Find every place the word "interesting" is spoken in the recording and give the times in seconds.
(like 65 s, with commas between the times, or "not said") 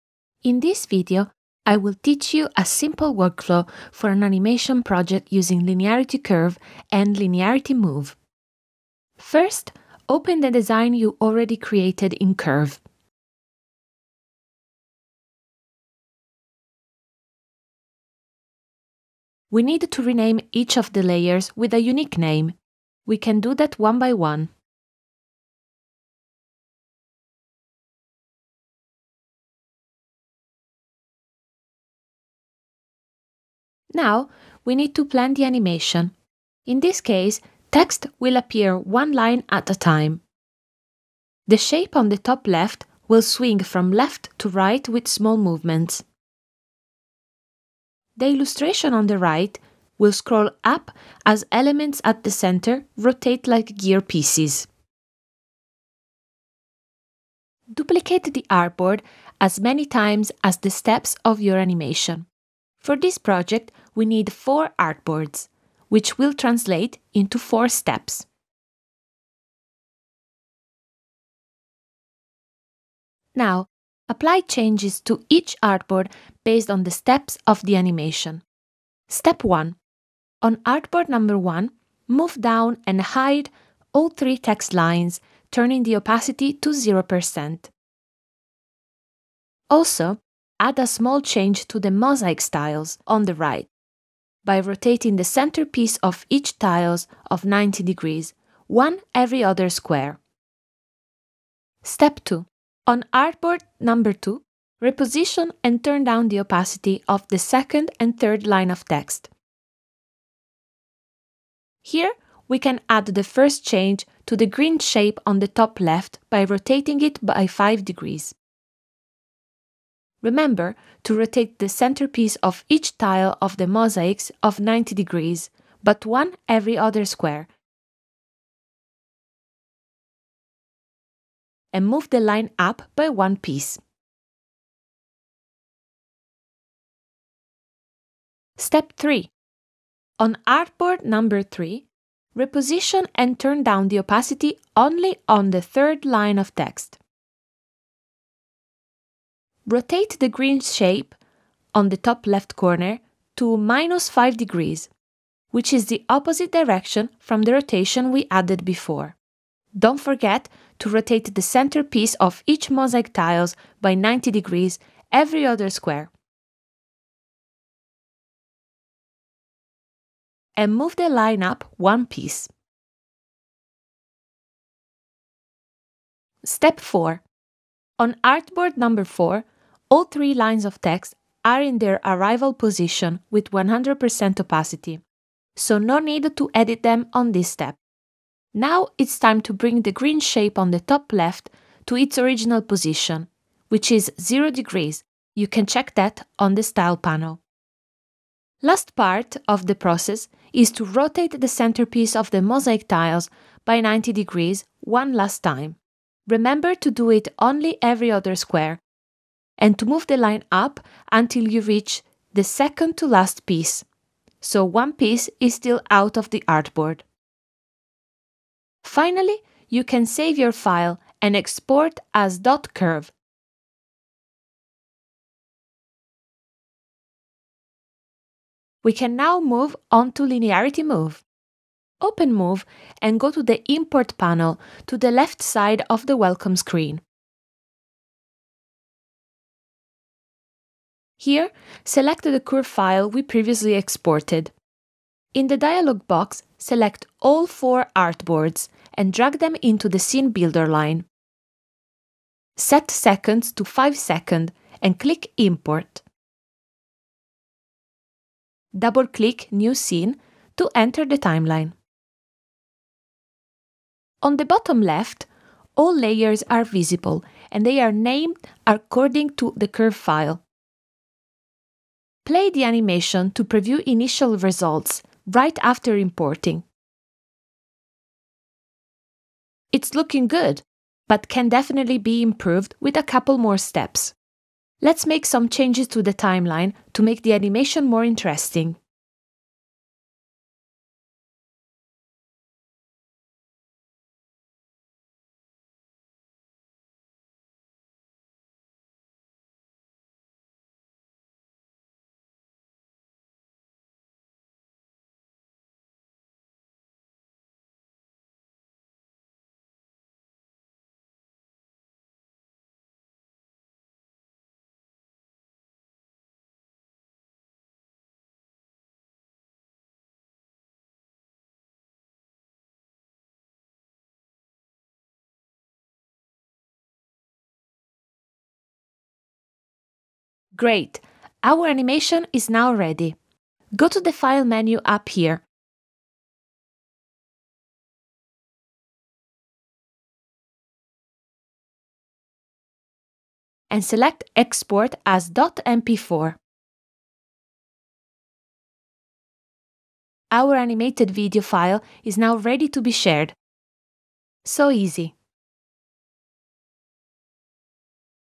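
288 s.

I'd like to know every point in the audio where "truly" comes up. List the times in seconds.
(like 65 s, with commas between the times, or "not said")
not said.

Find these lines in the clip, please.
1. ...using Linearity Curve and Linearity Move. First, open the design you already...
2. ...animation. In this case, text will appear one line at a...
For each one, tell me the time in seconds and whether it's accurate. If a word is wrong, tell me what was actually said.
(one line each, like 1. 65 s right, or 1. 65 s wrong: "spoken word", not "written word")
1. 5 s right
2. 35 s right.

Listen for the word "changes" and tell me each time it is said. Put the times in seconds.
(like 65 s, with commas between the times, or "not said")
74 s, 91 s, 113 s, 285 s.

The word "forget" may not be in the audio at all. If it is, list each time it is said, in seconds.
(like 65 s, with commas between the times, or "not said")
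159 s.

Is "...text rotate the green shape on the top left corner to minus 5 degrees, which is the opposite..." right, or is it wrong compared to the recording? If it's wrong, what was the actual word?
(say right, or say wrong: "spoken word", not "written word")
right.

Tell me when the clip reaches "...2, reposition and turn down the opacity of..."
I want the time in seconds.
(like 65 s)
104 s.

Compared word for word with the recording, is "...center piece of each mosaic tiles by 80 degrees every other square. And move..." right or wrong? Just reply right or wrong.
wrong.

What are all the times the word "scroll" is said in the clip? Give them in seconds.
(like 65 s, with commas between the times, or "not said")
50 s.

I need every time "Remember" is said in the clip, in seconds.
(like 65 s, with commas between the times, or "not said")
120 s, 206 s.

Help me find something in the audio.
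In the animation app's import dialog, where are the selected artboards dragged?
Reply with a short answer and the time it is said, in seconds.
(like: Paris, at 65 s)
Scene Builder, at 249 s.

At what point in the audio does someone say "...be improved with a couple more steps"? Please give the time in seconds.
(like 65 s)
281 s.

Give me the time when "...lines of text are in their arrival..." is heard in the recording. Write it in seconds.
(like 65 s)
180 s.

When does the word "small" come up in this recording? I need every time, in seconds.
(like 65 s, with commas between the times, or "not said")
45 s, 90 s.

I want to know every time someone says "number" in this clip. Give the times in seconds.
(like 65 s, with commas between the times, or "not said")
81 s, 103 s, 141 s, 178 s.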